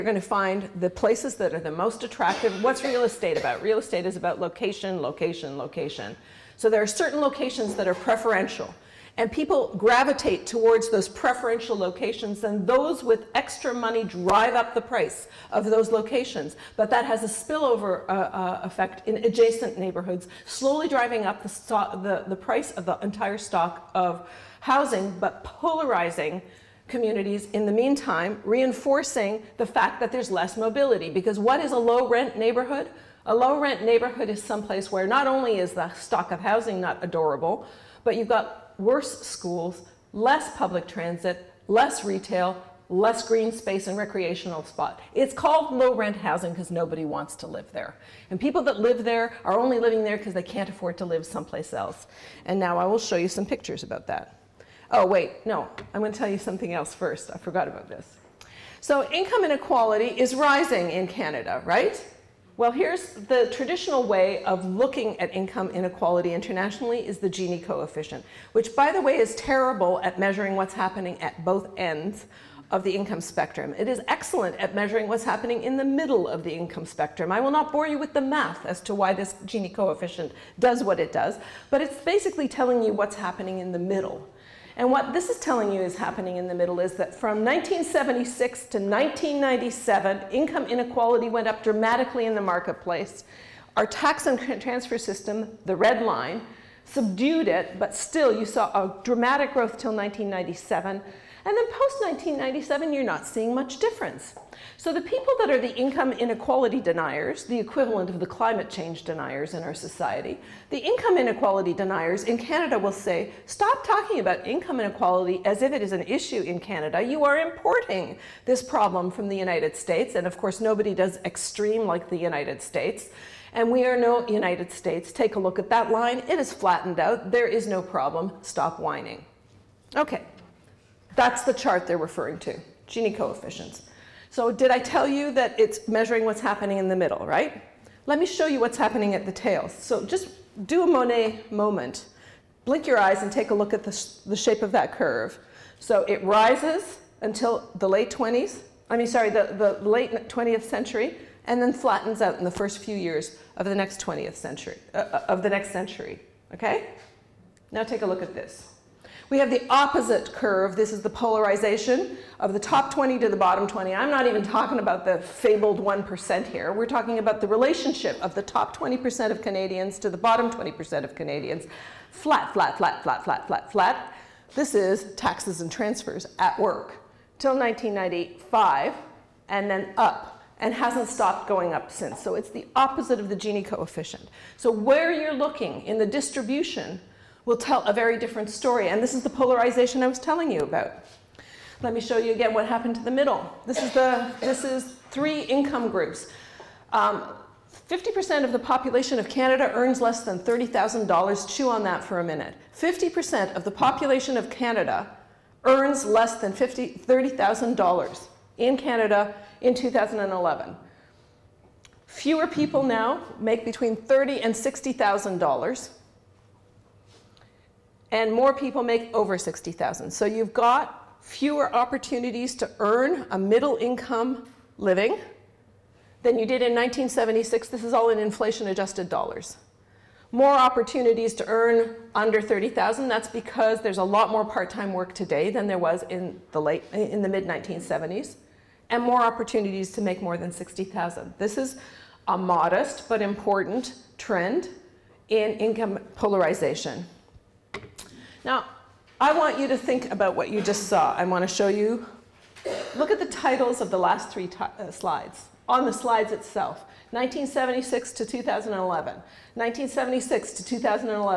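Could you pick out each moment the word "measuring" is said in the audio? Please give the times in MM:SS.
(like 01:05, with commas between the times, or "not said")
01:10, 01:14, 02:15.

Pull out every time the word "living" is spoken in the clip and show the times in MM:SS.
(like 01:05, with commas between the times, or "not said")
00:49, 03:44.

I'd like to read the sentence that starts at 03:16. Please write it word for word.
50% um, of the population of Canada earns less than $30,000.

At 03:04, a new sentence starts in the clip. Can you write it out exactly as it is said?
So where you're looking in the distribution will tell a very different story.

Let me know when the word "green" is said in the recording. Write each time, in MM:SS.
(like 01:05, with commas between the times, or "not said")
00:43.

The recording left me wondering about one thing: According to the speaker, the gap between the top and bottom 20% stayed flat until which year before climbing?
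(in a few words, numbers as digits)
1995.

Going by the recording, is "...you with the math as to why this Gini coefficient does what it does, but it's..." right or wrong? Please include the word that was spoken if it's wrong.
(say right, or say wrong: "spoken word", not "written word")
right.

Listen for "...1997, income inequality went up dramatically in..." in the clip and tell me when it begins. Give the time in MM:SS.
01:28.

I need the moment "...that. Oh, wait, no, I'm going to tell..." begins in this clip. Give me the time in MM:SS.
00:54.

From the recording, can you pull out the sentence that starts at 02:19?
So just do a Monet moment.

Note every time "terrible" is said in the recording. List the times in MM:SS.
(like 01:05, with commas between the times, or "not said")
01:09.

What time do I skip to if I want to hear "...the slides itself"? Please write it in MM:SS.
04:15.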